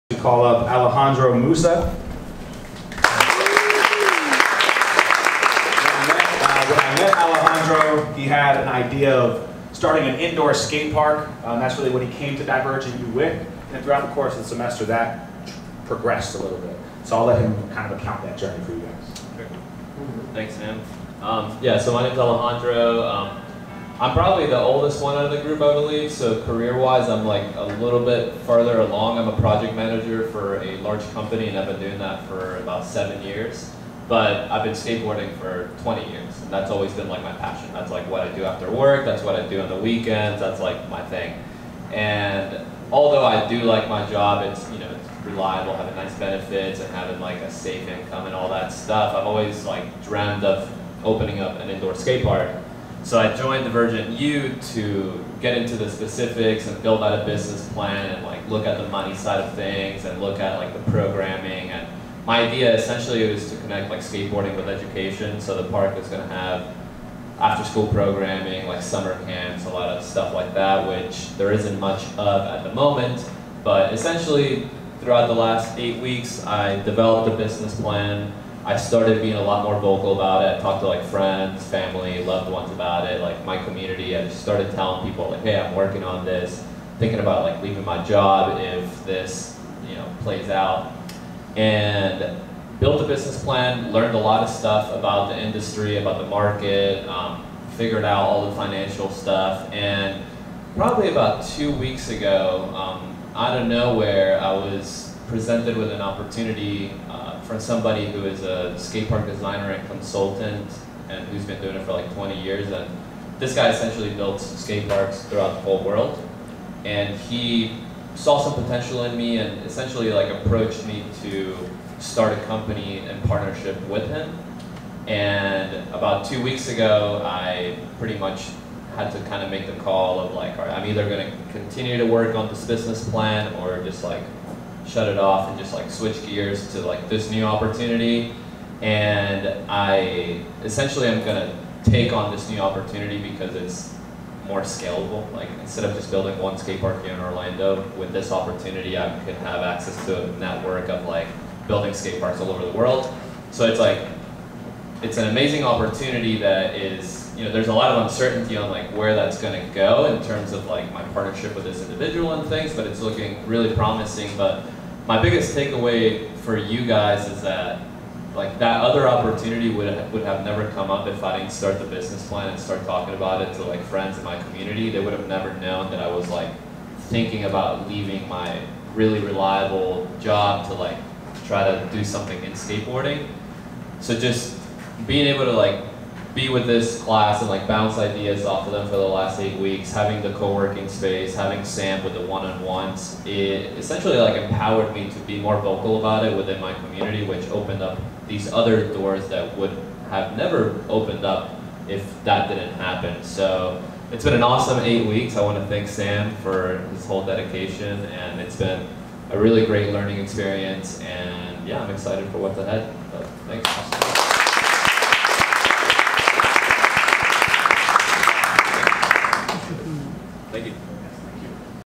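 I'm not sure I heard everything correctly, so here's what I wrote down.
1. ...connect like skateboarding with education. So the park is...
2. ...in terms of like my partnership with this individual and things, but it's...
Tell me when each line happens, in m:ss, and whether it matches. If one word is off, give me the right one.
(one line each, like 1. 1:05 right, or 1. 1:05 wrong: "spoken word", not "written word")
1. 1:03 right
2. 2:40 right.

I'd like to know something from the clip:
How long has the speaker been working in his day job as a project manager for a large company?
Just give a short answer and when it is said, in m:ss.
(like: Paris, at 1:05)
7 years, at 0:32.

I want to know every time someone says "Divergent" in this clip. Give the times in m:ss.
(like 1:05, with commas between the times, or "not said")
0:12, 0:53.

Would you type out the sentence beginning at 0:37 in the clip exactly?
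That's like what I do after work, that's what I do on the weekends, that's like my thing.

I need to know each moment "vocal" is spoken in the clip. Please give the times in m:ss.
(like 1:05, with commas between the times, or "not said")
1:19, 3:15.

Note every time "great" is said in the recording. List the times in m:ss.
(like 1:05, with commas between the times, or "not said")
3:29.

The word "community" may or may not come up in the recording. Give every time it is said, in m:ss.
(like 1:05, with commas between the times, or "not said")
1:23, 2:54, 3:16.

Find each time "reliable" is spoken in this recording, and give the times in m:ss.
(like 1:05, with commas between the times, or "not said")
0:45, 2:59.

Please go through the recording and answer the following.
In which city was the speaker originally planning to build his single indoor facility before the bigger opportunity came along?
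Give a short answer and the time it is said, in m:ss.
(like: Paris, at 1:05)
Orlando, at 2:27.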